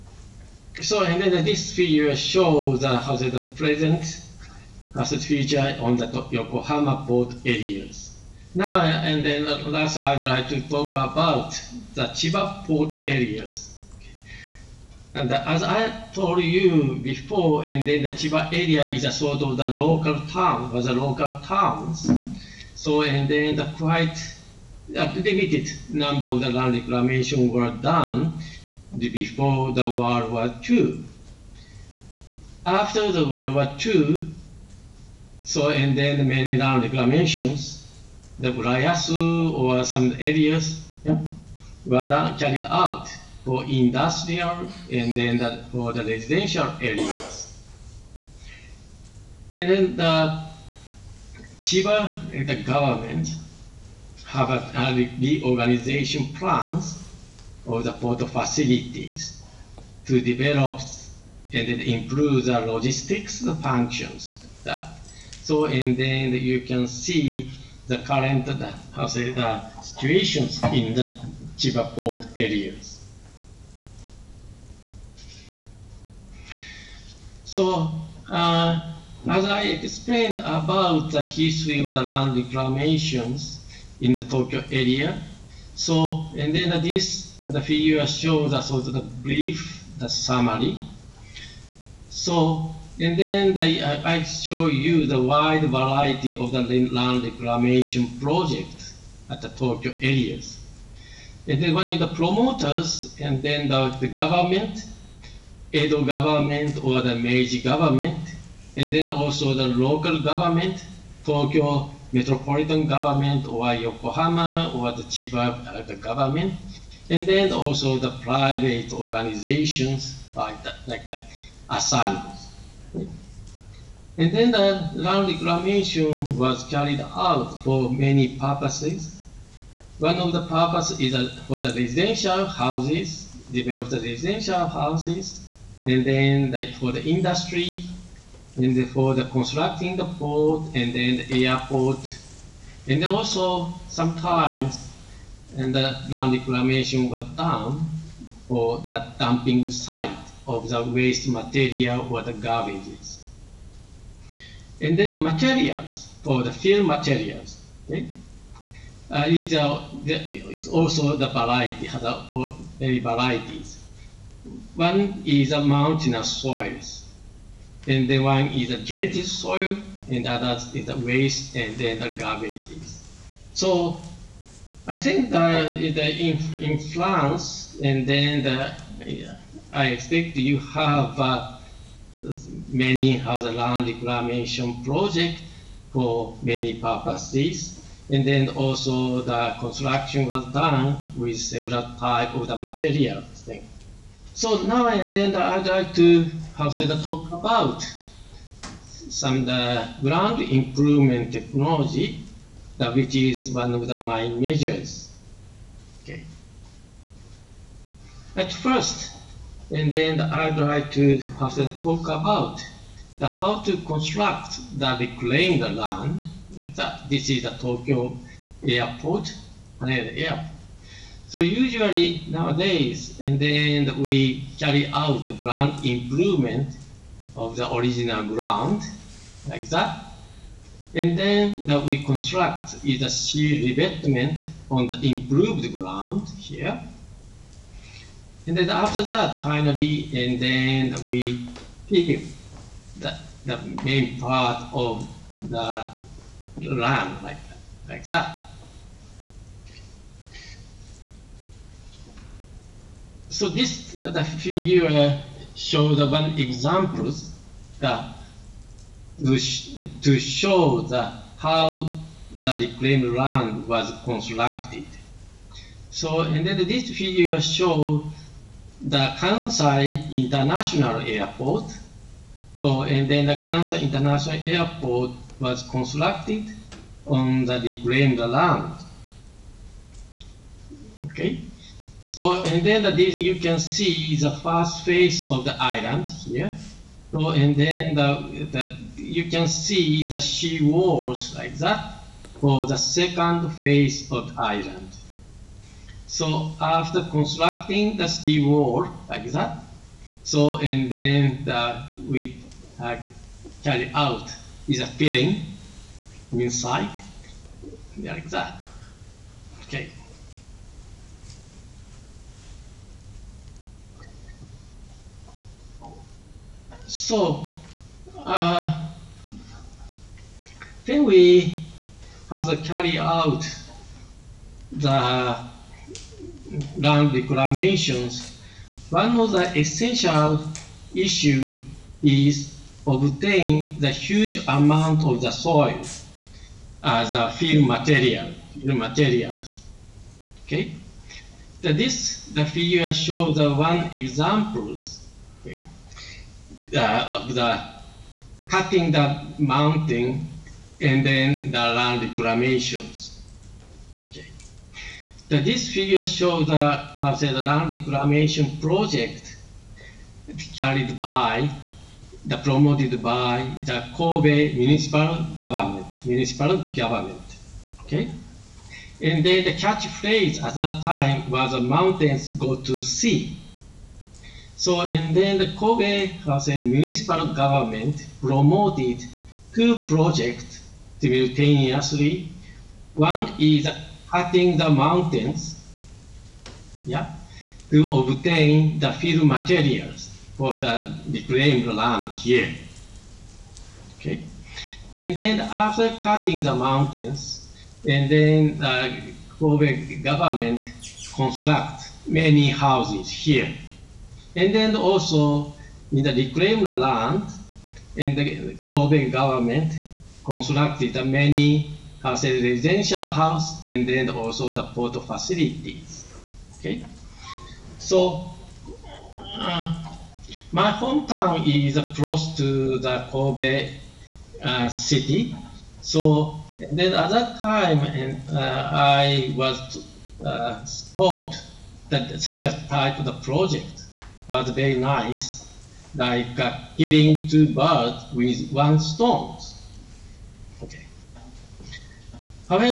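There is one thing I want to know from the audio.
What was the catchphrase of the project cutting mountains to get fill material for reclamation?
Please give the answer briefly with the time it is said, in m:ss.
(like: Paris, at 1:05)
mountains go to sea, at 6:11.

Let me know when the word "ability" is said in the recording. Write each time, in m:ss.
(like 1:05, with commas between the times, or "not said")
not said.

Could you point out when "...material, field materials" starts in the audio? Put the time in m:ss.
5:37.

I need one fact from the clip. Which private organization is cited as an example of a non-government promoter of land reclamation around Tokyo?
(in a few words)
the Asanos.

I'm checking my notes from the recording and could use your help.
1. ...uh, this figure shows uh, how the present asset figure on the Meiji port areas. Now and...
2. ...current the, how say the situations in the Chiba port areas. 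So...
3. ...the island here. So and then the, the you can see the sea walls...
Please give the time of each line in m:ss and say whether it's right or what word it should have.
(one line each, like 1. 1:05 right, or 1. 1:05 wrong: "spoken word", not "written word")
1. 0:01 wrong: "Yokohama", not "Meiji"
2. 1:07 right
3. 4:45 right.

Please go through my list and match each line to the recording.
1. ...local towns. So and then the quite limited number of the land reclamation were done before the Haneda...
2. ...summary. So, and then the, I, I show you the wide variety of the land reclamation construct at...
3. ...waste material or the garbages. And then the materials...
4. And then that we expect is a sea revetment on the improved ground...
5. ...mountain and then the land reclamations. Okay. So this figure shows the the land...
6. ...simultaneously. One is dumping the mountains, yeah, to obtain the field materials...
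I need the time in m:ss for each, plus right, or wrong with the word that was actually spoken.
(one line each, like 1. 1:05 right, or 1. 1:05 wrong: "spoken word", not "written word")
1. 0:20 wrong: "World", not "Haneda"
2. 1:30 wrong: "project", not "construct"
3. 2:30 right
4. 3:50 wrong: "construct", not "expect"
5. 5:49 right
6. 6:21 wrong: "cutting", not "dumping".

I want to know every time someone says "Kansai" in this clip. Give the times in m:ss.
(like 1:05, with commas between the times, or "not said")
4:29, 4:33.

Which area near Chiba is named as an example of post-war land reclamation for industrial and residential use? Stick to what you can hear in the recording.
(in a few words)
Urayasu.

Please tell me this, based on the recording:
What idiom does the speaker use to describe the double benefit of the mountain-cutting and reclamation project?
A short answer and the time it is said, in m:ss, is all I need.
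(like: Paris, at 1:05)
hitting two birds with one stone, at 7:16.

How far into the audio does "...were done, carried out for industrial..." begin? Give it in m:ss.
0:41.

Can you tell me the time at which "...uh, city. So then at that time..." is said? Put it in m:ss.
7:04.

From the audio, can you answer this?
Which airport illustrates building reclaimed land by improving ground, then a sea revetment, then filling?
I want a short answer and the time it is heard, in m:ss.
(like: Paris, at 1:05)
Haneda airport, at 3:39.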